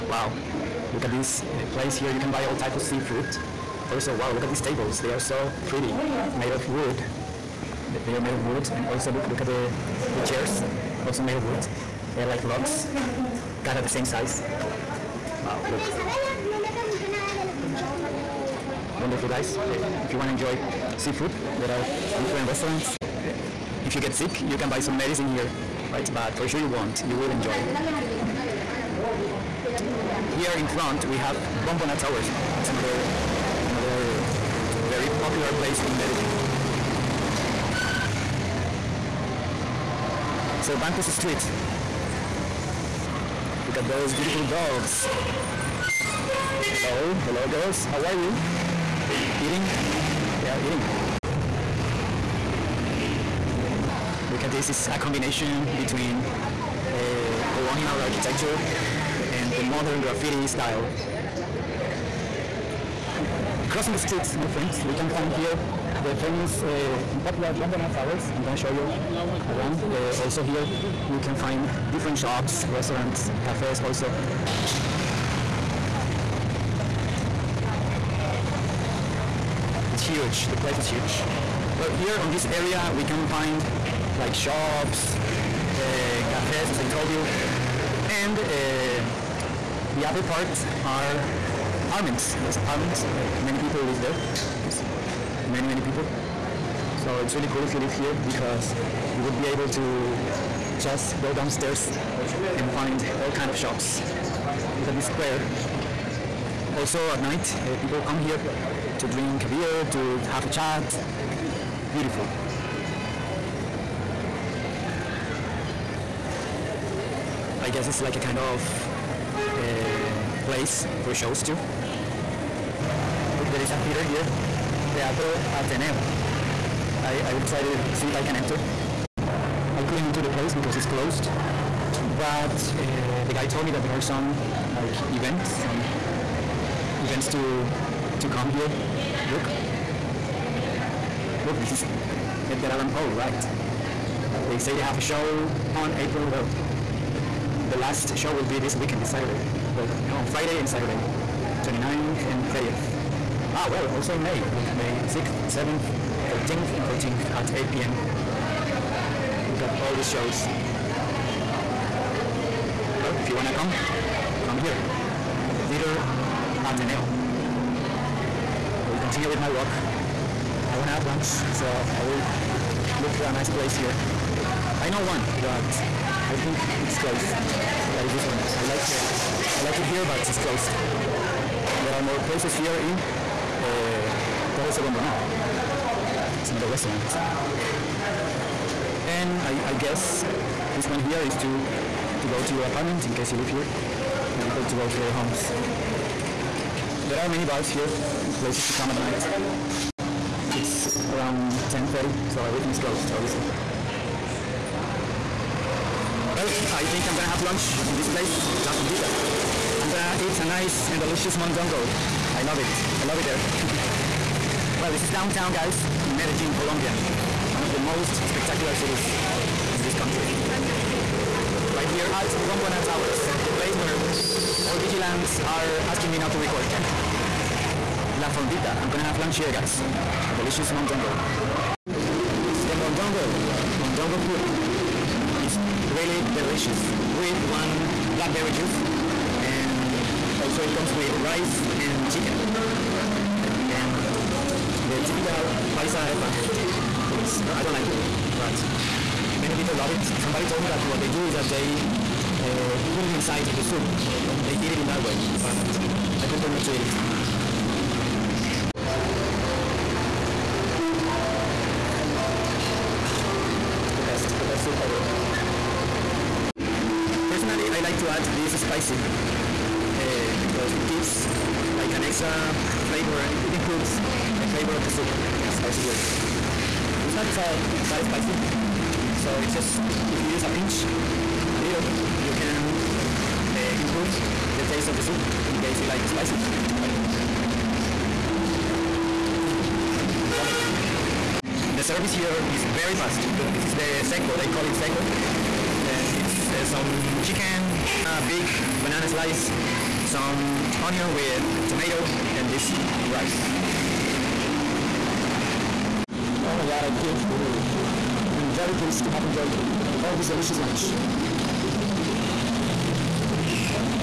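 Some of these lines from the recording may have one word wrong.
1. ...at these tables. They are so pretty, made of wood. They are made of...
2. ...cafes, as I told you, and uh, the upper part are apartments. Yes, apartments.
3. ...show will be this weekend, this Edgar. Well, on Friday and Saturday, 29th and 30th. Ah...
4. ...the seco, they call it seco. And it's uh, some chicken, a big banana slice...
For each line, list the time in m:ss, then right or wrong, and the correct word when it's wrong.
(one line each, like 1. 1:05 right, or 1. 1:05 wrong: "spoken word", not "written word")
1. 0:04 right
2. 1:26 right
3. 2:28 wrong: "Saturday", not "Edgar"
4. 4:53 right.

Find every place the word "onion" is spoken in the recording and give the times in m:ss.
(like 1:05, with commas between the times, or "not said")
5:00.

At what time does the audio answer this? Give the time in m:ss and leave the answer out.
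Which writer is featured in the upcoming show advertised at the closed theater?
2:22.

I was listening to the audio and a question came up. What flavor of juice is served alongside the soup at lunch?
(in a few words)
Blackberry.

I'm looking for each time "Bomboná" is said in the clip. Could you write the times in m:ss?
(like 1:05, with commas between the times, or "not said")
0:31, 1:07, 3:04, 3:42.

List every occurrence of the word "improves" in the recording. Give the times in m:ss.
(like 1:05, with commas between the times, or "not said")
4:33, 4:43.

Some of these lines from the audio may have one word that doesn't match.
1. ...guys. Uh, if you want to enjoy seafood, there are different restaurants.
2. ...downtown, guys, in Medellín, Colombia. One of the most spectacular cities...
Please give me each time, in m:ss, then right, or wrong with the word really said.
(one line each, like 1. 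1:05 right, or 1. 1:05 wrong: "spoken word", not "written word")
1. 0:19 right
2. 3:35 right.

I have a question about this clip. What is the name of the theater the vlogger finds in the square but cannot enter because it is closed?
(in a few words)
Teatro Ateneo.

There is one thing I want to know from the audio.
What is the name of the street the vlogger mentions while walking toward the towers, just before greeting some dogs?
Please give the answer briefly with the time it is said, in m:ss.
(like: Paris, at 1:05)
Cervantes Street, at 0:40.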